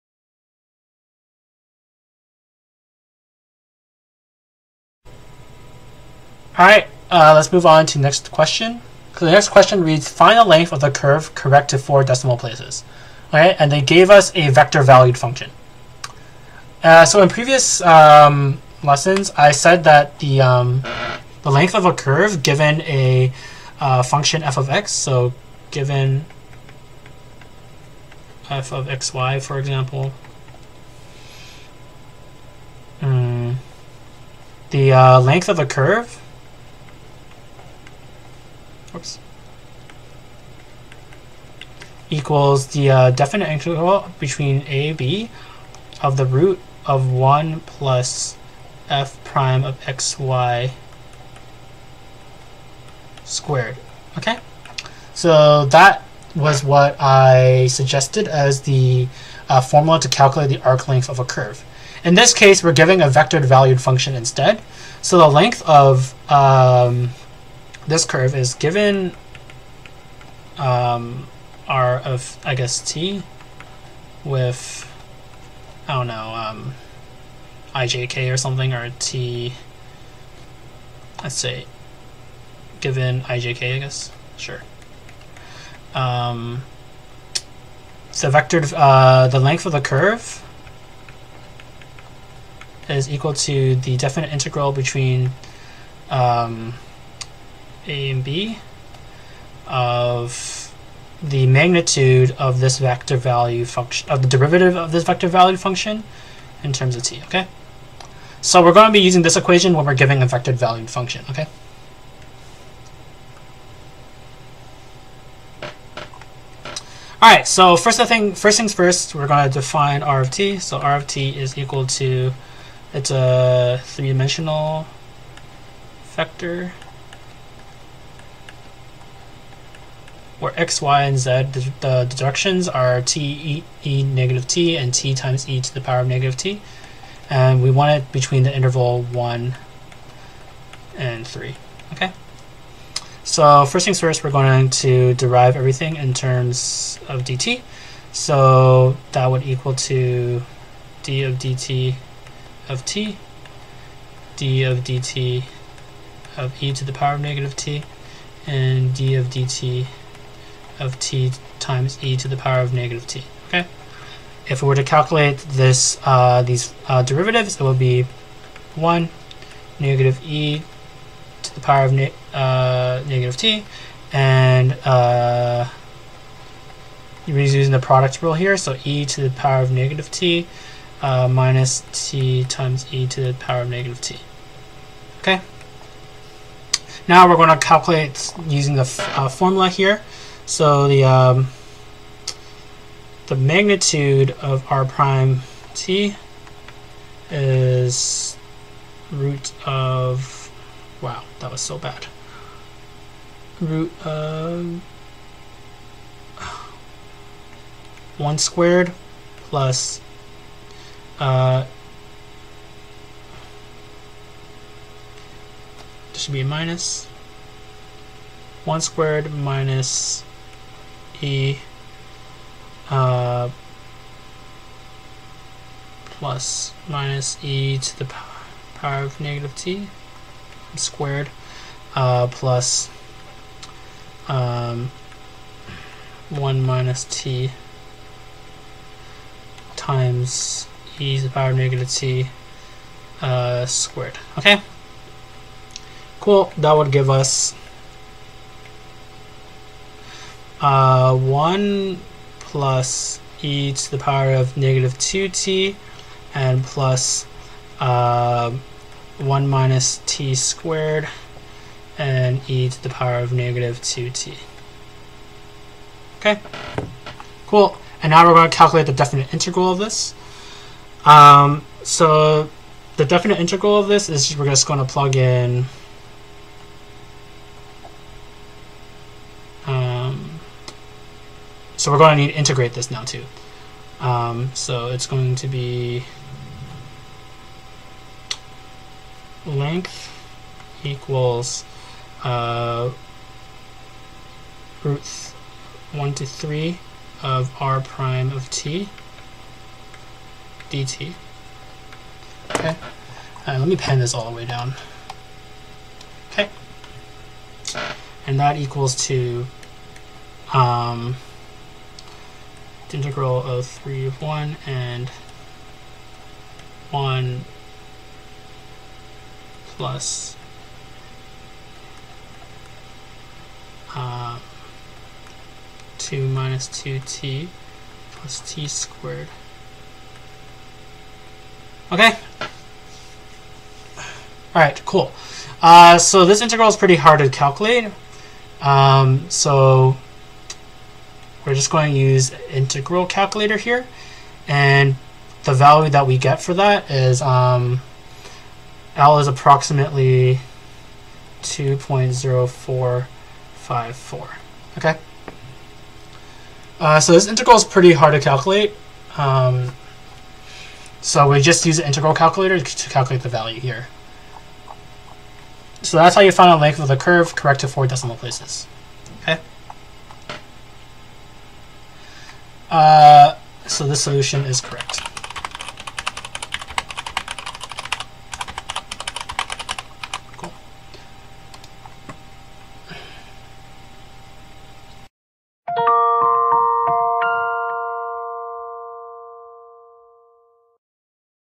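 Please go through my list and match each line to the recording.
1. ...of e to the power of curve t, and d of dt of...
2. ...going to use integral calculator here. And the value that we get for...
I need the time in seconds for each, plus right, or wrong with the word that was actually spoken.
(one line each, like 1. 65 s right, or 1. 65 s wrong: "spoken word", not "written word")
1. 156 s wrong: "negative", not "curve"
2. 341 s right.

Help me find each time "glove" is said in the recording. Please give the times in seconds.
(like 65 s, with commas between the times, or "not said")
not said.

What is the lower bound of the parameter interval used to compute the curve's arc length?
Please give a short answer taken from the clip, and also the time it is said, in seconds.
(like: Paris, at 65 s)
1, at 138 s.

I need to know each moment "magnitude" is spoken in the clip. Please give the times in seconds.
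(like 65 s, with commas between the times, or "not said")
101 s, 193 s.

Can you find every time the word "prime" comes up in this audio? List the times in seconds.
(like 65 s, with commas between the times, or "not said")
49 s, 194 s, 297 s.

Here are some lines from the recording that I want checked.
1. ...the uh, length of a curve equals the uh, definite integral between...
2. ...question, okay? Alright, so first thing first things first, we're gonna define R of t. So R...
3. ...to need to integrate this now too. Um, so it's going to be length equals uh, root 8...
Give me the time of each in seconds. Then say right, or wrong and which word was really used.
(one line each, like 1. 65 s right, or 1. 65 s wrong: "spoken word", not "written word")
1. 34 s right
2. 110 s wrong: "function", not "question"
3. 282 s wrong: "1", not "8".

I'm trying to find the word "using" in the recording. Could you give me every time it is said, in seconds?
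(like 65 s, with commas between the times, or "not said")
109 s, 177 s, 188 s.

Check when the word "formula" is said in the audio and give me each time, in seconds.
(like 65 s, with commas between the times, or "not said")
59 s, 189 s.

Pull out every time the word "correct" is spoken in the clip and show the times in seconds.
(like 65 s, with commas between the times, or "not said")
11 s, 367 s, 374 s.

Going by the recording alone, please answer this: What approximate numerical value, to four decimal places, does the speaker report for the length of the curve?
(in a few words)
2.0454.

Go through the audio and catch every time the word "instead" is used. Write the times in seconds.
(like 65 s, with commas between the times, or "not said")
64 s.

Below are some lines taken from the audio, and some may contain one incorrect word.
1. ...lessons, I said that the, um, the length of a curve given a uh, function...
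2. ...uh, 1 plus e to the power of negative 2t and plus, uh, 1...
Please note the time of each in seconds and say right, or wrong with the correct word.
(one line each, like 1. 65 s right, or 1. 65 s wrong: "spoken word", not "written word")
1. 18 s right
2. 250 s right.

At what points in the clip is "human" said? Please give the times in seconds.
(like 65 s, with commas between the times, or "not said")
not said.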